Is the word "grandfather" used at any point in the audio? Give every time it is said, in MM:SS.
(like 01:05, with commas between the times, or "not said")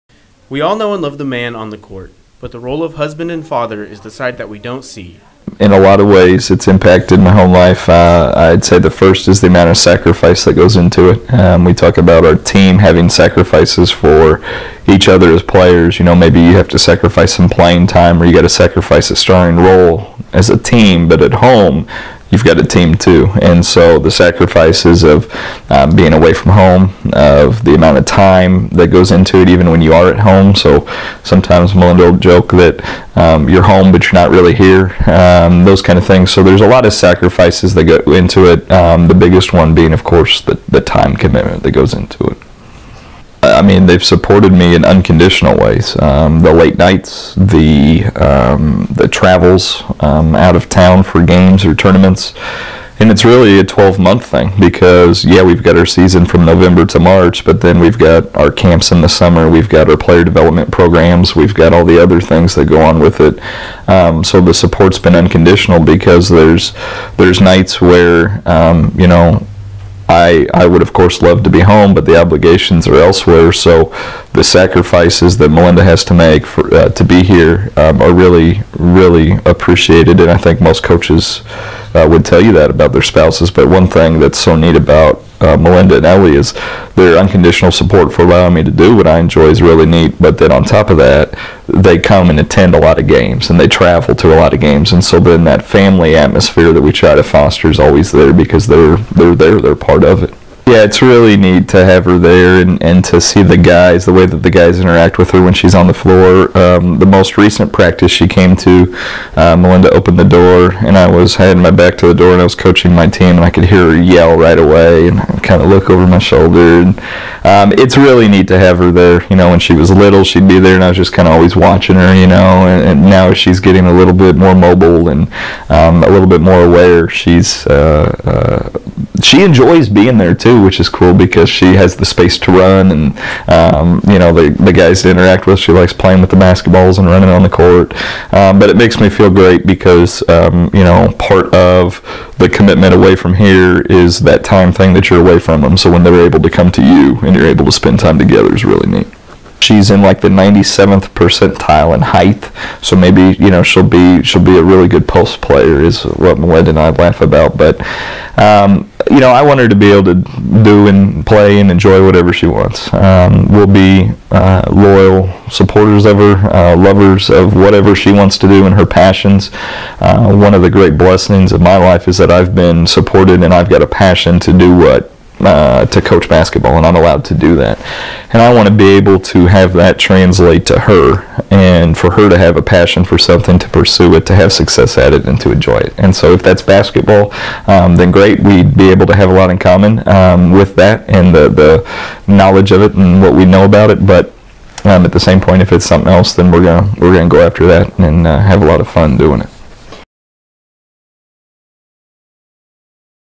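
not said.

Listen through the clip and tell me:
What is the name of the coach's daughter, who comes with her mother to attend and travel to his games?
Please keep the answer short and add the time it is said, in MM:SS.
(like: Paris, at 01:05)
Ellie, at 01:26.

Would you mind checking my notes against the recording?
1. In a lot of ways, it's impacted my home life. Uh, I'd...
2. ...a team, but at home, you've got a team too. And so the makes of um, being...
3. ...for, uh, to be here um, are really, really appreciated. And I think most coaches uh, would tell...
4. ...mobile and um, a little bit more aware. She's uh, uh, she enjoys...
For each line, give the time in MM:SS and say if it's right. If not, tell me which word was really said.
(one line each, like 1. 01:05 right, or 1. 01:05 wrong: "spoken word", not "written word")
1. 00:05 right
2. 00:20 wrong: "sacrifices", not "makes"
3. 01:16 right
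4. 02:04 right.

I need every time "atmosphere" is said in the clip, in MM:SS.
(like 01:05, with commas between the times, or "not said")
01:36.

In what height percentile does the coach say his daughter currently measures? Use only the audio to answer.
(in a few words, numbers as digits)
97th.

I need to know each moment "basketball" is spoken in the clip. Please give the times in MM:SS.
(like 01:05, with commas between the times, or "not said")
02:16, 02:56, 03:06.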